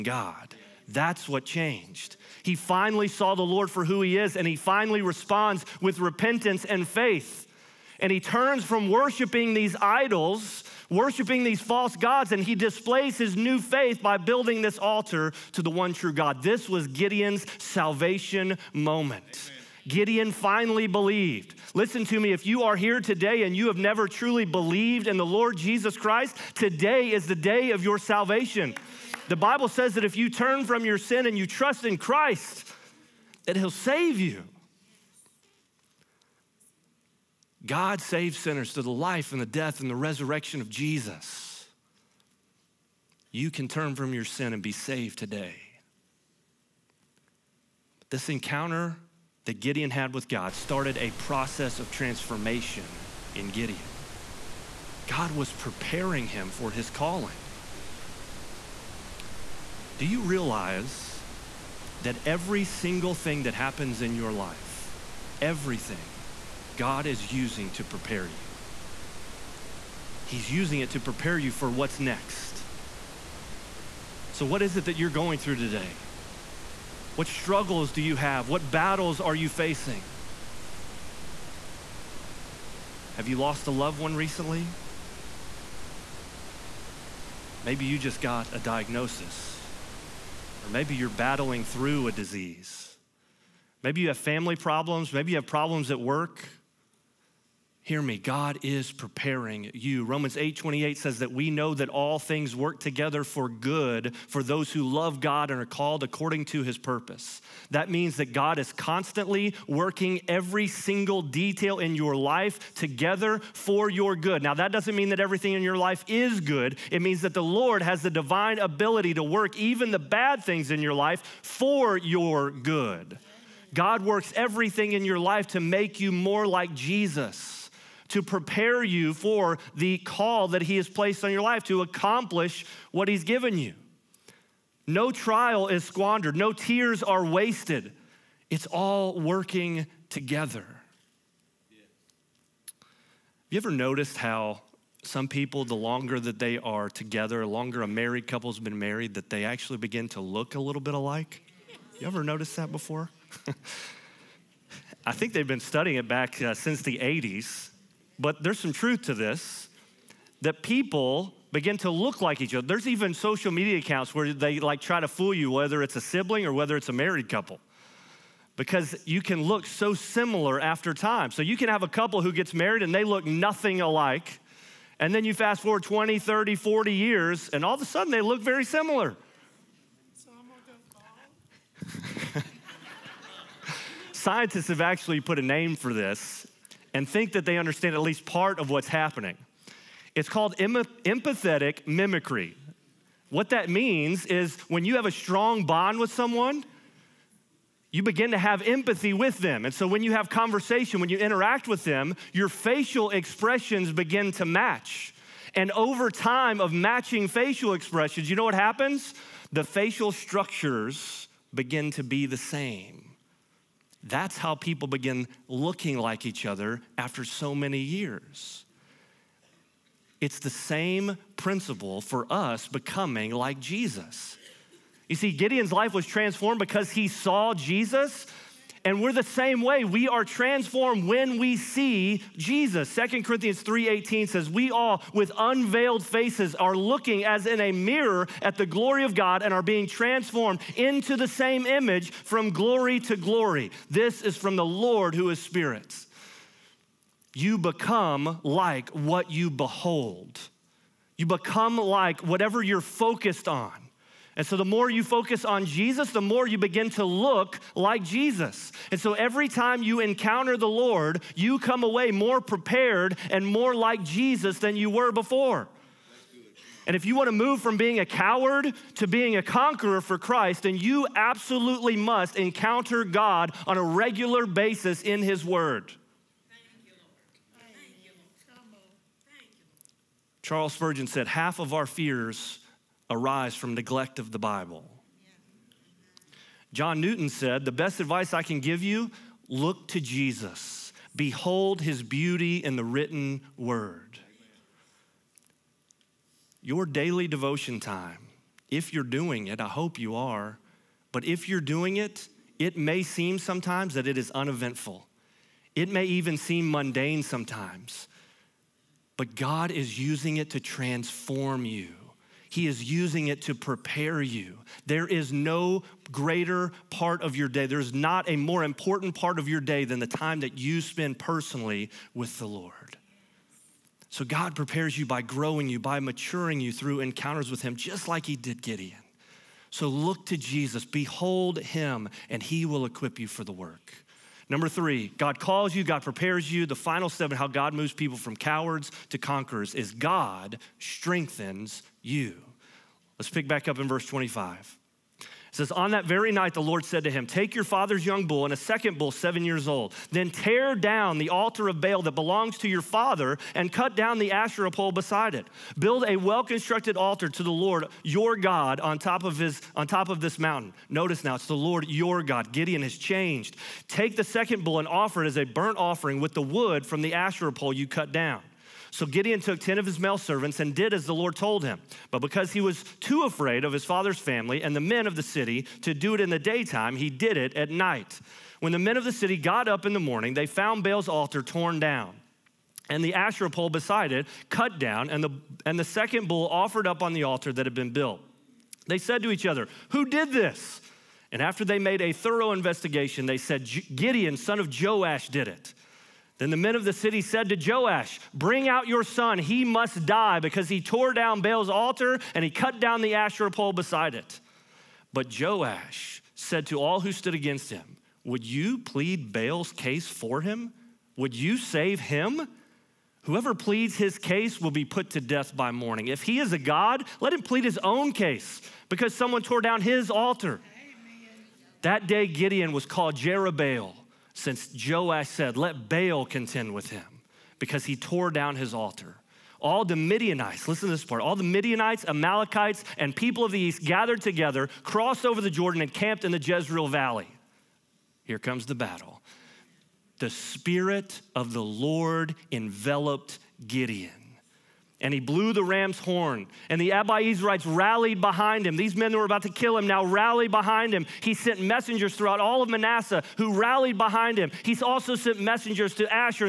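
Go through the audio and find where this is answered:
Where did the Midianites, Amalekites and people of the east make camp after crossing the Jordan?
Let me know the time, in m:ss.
7:16.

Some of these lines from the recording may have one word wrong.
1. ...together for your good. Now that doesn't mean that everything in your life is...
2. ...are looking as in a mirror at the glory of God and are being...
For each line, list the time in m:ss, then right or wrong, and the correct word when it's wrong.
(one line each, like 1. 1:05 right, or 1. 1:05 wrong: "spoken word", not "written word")
1. 1:52 right
2. 3:56 right.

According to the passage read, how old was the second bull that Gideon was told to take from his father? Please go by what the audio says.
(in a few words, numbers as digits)
7 years.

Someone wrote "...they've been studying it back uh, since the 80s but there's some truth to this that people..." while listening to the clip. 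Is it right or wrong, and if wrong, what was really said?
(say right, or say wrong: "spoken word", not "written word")
right.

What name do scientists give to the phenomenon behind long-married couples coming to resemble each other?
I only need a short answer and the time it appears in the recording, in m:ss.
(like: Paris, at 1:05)
Empathetic mimicry, at 3:11.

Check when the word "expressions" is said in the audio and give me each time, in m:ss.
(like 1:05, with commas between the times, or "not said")
3:23, 3:27.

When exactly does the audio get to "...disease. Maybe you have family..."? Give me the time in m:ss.
1:32.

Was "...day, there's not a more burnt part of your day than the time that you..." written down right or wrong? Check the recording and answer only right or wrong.
wrong.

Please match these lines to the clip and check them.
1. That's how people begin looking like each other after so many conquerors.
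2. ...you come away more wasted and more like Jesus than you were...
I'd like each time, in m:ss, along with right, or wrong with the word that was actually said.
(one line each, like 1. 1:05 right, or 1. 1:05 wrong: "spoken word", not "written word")
1. 3:34 wrong: "years", not "conquerors"
2. 4:21 wrong: "prepared", not "wasted".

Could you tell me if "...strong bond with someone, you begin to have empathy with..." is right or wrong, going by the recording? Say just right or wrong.
right.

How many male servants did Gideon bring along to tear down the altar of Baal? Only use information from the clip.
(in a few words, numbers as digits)
10.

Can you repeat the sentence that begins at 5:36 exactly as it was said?
The final step in how God moves people from cowards to conquerors is God strengthens you.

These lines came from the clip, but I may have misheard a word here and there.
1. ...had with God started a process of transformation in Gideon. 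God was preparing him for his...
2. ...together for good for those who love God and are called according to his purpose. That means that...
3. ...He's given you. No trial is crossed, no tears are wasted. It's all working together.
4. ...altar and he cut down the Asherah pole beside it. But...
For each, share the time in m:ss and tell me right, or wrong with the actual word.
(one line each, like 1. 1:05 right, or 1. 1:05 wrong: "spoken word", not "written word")
1. 0:49 right
2. 1:42 right
3. 2:13 wrong: "squandered", not "crossed"
4. 6:41 right.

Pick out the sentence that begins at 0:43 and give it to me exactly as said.
You can turn from your sin and be saved today.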